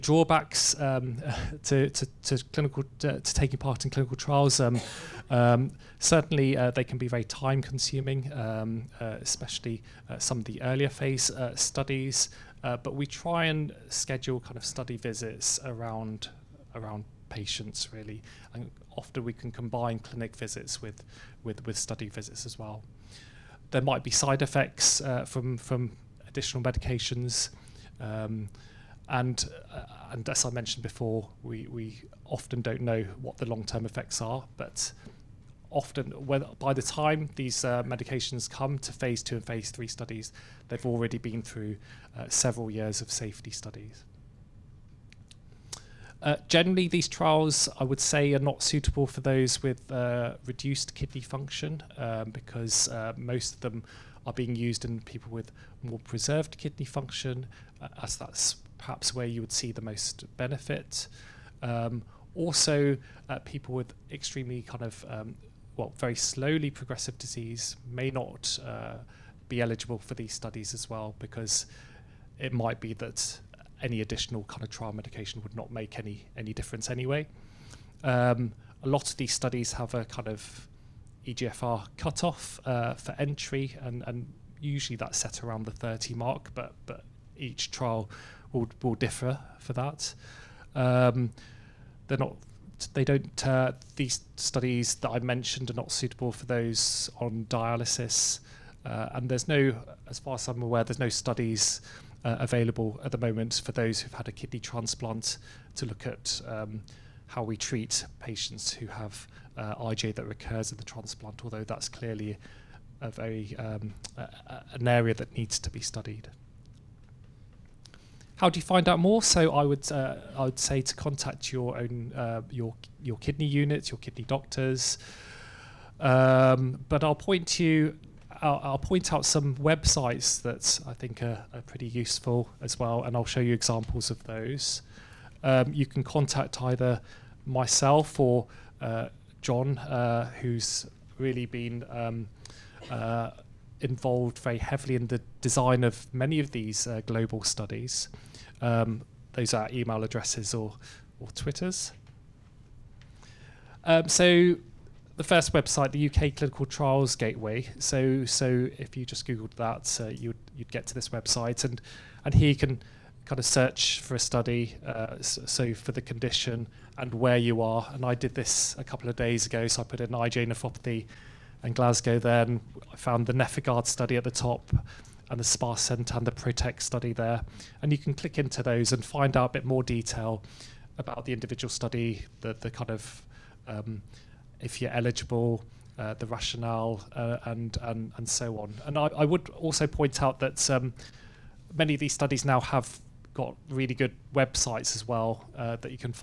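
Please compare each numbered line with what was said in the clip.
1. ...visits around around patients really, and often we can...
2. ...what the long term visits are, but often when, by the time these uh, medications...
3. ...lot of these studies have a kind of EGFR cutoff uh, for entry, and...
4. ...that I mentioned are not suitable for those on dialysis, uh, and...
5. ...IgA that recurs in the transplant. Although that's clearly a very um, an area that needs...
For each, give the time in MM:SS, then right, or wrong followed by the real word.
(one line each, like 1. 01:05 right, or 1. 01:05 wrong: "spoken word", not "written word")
1. 00:14 right
2. 00:33 wrong: "effects", not "visits"
3. 01:18 right
4. 01:34 right
5. 01:49 right.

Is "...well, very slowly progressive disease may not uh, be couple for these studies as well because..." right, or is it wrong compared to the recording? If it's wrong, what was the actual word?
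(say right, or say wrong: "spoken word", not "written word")
wrong: "eligible", not "couple".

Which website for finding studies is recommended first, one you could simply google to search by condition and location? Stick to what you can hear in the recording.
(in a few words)
UK Clinical Trials Gateway.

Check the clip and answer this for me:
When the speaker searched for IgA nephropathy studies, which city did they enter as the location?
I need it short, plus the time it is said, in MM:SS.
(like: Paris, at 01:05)
Glasgow, at 02:51.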